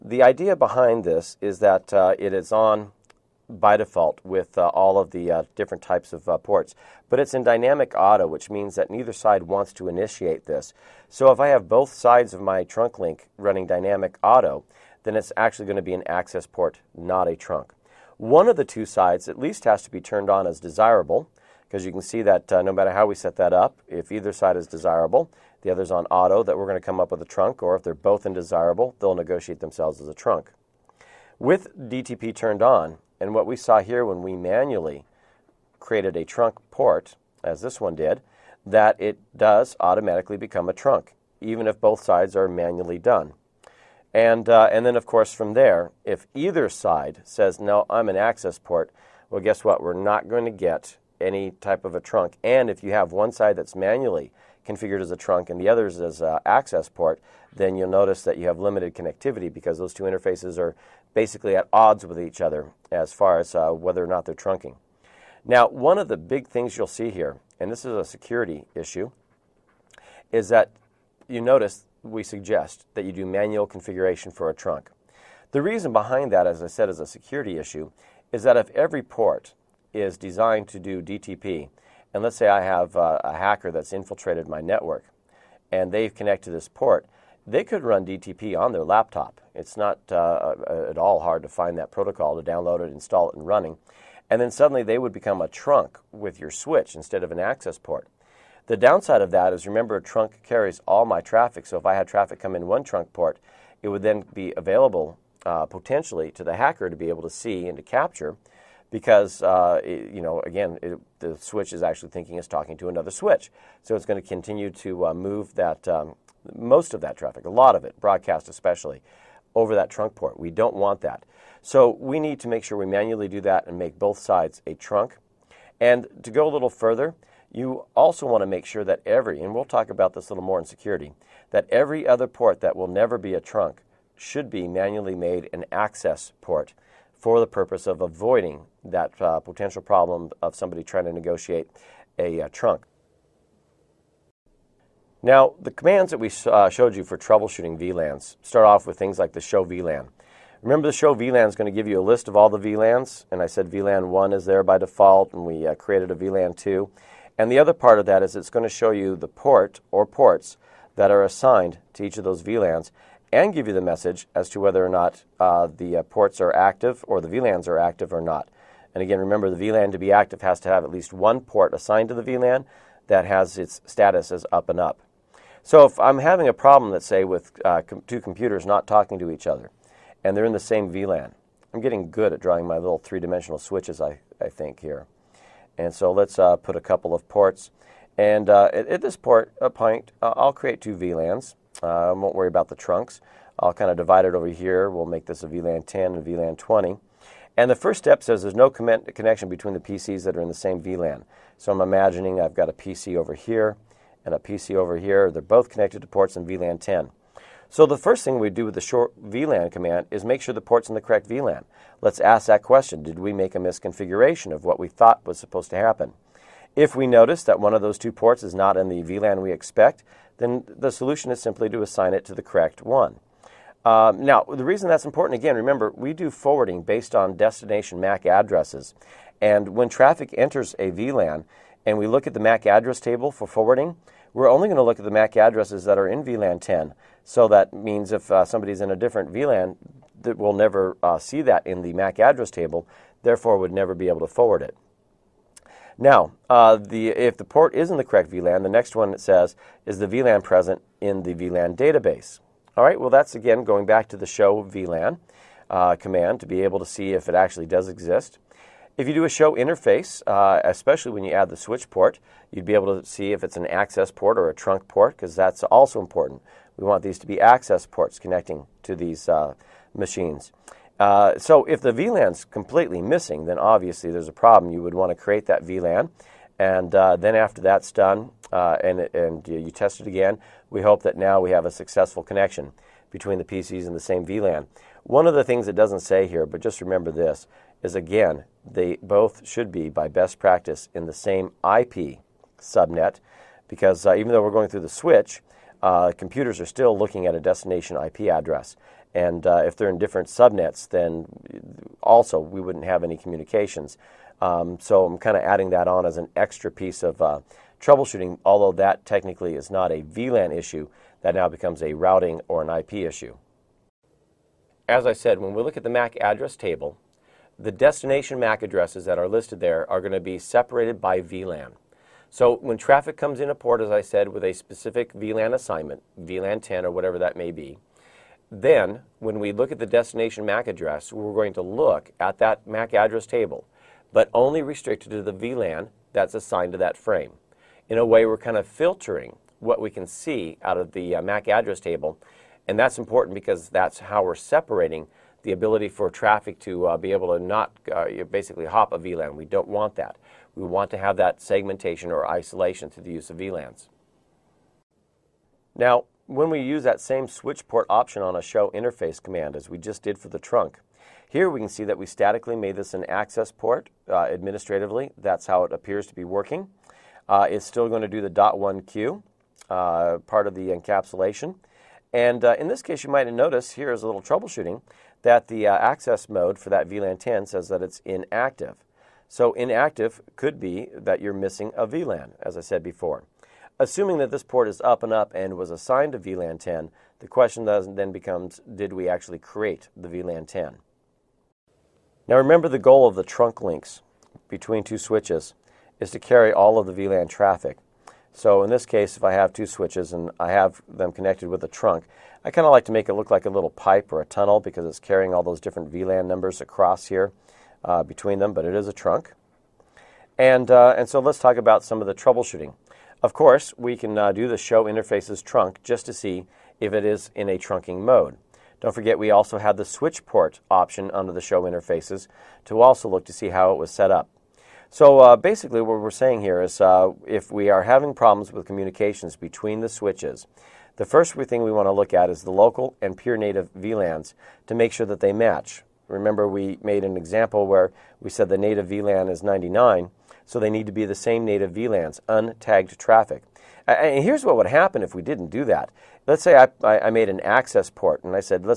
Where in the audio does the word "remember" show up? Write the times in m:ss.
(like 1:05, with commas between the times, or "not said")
1:39, 2:30, 2:49, 3:45, 4:46, 6:32, 7:16.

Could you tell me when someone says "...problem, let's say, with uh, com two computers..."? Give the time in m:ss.
2:56.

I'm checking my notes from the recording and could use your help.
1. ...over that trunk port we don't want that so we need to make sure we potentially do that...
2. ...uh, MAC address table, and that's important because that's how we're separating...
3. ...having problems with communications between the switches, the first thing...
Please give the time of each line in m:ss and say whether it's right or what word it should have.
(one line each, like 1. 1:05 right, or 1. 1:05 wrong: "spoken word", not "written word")
1. 1:59 wrong: "manually", not "potentially"
2. 5:41 right
3. 7:07 right.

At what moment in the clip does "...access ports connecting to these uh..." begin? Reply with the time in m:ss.
4:27.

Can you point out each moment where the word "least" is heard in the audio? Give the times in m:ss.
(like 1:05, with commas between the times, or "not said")
0:19, 2:50.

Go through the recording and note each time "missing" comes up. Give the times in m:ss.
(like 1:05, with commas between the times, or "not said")
4:33, 6:21.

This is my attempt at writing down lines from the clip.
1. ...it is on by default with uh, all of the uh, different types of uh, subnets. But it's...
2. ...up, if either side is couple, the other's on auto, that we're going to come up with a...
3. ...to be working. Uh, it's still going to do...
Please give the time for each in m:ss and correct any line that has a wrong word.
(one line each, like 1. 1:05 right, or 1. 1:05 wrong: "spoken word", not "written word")
1. 0:02 wrong: "ports", not "subnets"
2. 0:23 wrong: "desirable", not "couple"
3. 6:06 right.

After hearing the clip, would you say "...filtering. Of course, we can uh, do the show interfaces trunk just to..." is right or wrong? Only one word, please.
wrong.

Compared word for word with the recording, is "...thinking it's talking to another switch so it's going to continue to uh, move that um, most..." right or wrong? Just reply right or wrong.
right.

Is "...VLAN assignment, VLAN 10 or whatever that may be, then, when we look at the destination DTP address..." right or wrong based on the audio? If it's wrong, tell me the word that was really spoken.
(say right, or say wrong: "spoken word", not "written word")
wrong: "MAC", not "DTP".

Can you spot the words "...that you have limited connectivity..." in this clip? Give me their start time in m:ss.
0:58.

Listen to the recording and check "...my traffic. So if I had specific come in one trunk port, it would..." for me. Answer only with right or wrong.
wrong.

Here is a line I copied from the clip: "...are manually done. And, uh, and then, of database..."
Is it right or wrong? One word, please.
wrong.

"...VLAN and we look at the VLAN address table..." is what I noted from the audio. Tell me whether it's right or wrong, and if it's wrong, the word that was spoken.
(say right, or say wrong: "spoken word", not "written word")
wrong: "MAC", not "VLAN".